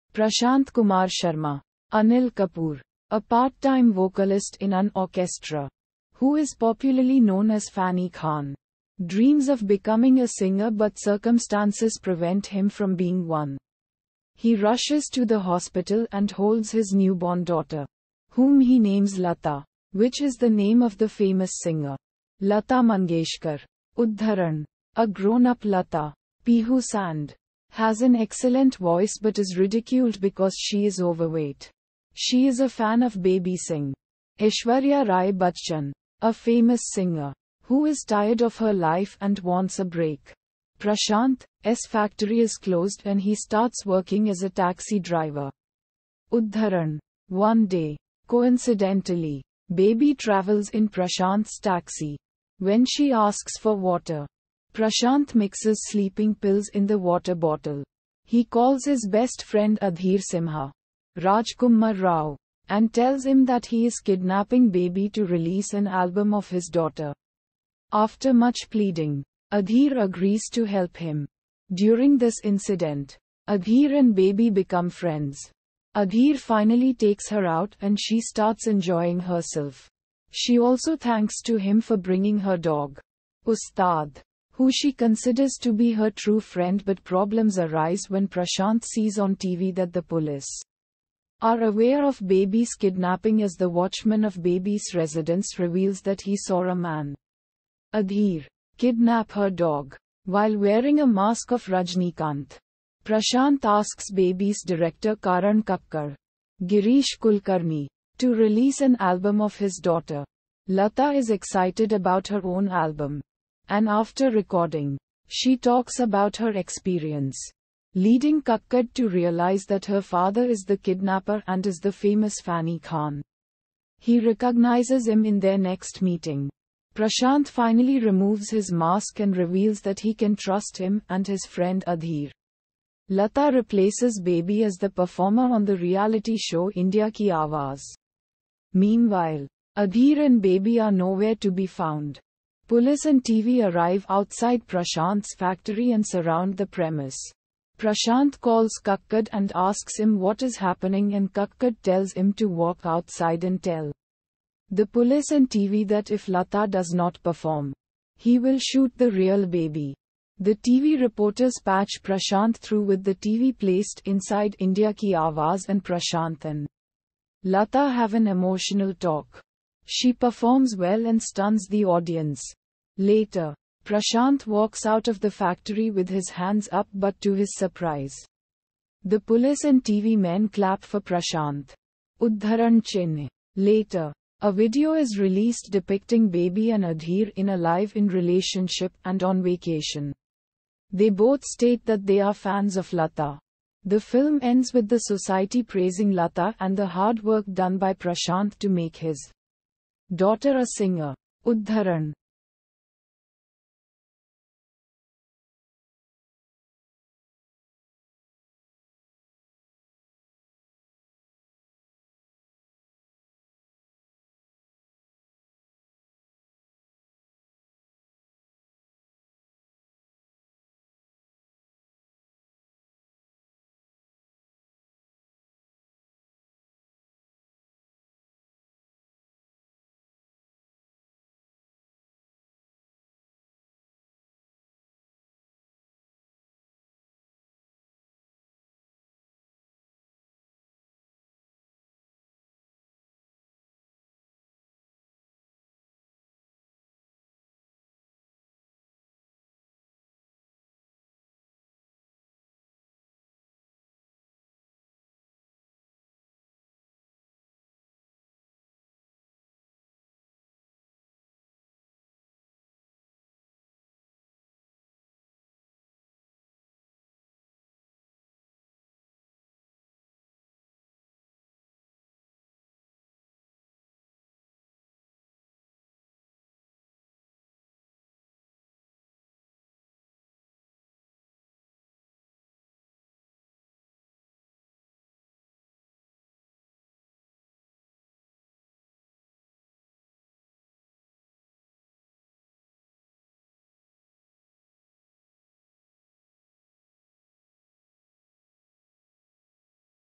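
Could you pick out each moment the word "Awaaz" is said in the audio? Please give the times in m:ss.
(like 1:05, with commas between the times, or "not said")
2:17, 2:45.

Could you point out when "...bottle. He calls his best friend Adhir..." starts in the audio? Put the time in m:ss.
0:57.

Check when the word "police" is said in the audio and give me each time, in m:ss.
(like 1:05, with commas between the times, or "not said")
1:30, 2:22, 2:34, 2:59.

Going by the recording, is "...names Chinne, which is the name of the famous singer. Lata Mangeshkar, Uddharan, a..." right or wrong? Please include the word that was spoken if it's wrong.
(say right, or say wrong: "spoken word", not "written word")
wrong: "Lata", not "Chinne".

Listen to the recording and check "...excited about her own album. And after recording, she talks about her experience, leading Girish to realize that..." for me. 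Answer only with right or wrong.
wrong.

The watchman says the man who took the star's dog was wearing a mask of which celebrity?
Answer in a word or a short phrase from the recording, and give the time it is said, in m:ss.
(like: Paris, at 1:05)
Rajnikant, at 1:41.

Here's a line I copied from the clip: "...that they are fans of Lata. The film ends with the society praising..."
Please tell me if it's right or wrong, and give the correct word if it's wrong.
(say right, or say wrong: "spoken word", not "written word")
right.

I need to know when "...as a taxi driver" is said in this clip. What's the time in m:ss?
0:44.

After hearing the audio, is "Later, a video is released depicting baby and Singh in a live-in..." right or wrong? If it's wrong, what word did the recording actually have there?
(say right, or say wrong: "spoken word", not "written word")
wrong: "Adhir", not "Singh".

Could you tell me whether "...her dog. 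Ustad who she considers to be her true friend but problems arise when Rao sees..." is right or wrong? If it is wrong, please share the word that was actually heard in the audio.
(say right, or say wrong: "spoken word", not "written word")
wrong: "Prashant", not "Rao".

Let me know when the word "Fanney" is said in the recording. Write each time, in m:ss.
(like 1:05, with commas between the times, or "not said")
0:07, 2:02.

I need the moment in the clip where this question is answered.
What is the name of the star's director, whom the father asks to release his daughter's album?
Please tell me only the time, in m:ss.
1:45.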